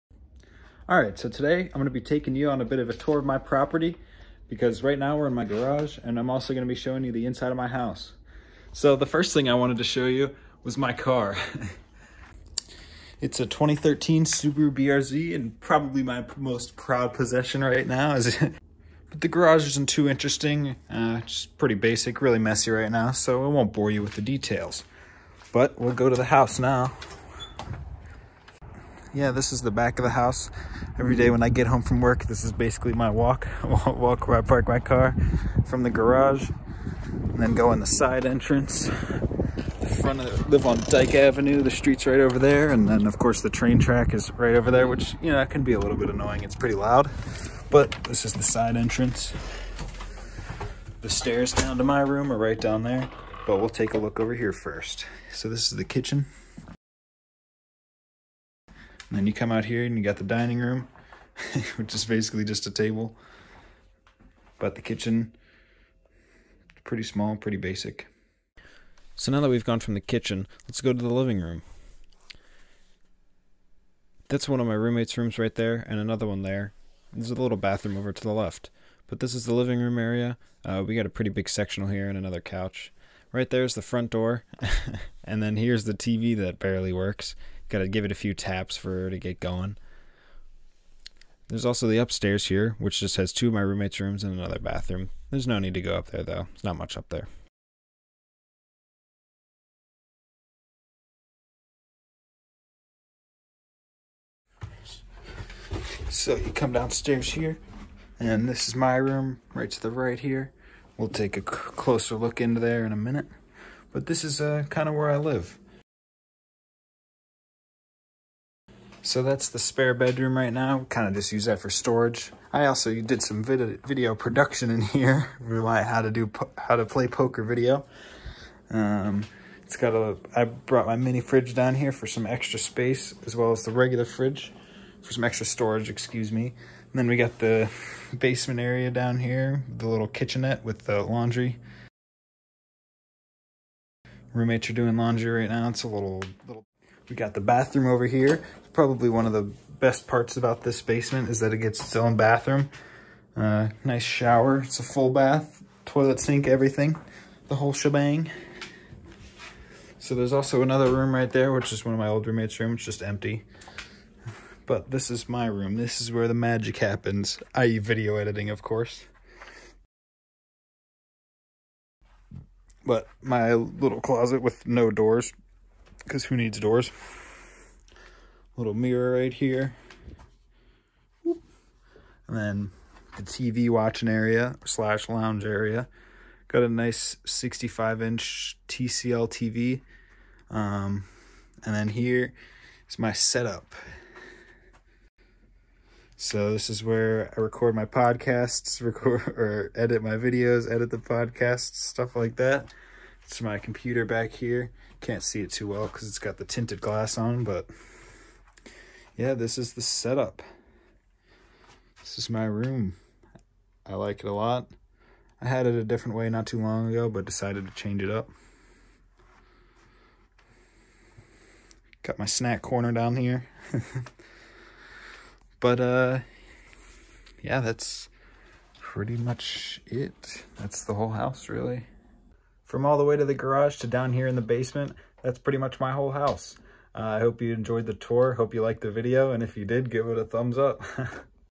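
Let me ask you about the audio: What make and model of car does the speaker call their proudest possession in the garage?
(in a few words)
Subaru BRZ.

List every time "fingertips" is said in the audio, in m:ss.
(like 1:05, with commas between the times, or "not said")
not said.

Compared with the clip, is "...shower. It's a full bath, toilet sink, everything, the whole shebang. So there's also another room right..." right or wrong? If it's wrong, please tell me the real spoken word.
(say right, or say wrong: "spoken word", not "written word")
right.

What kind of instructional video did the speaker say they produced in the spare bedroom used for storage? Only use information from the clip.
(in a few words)
How to play poker.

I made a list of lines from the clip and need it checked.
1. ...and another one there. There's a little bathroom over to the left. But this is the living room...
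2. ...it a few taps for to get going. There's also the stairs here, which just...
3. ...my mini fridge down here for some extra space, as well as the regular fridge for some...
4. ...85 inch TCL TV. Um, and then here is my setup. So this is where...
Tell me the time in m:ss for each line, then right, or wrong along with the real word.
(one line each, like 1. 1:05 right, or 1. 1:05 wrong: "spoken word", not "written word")
1. 1:15 right
2. 1:28 wrong: "upstairs", not "stairs"
3. 2:10 right
4. 3:07 wrong: "65", not "85".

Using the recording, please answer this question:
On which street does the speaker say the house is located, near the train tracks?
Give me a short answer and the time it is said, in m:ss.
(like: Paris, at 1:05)
Dyke Avenue, at 0:40.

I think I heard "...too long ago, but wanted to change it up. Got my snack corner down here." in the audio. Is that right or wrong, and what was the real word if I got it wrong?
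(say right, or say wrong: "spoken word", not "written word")
wrong: "decided", not "wanted".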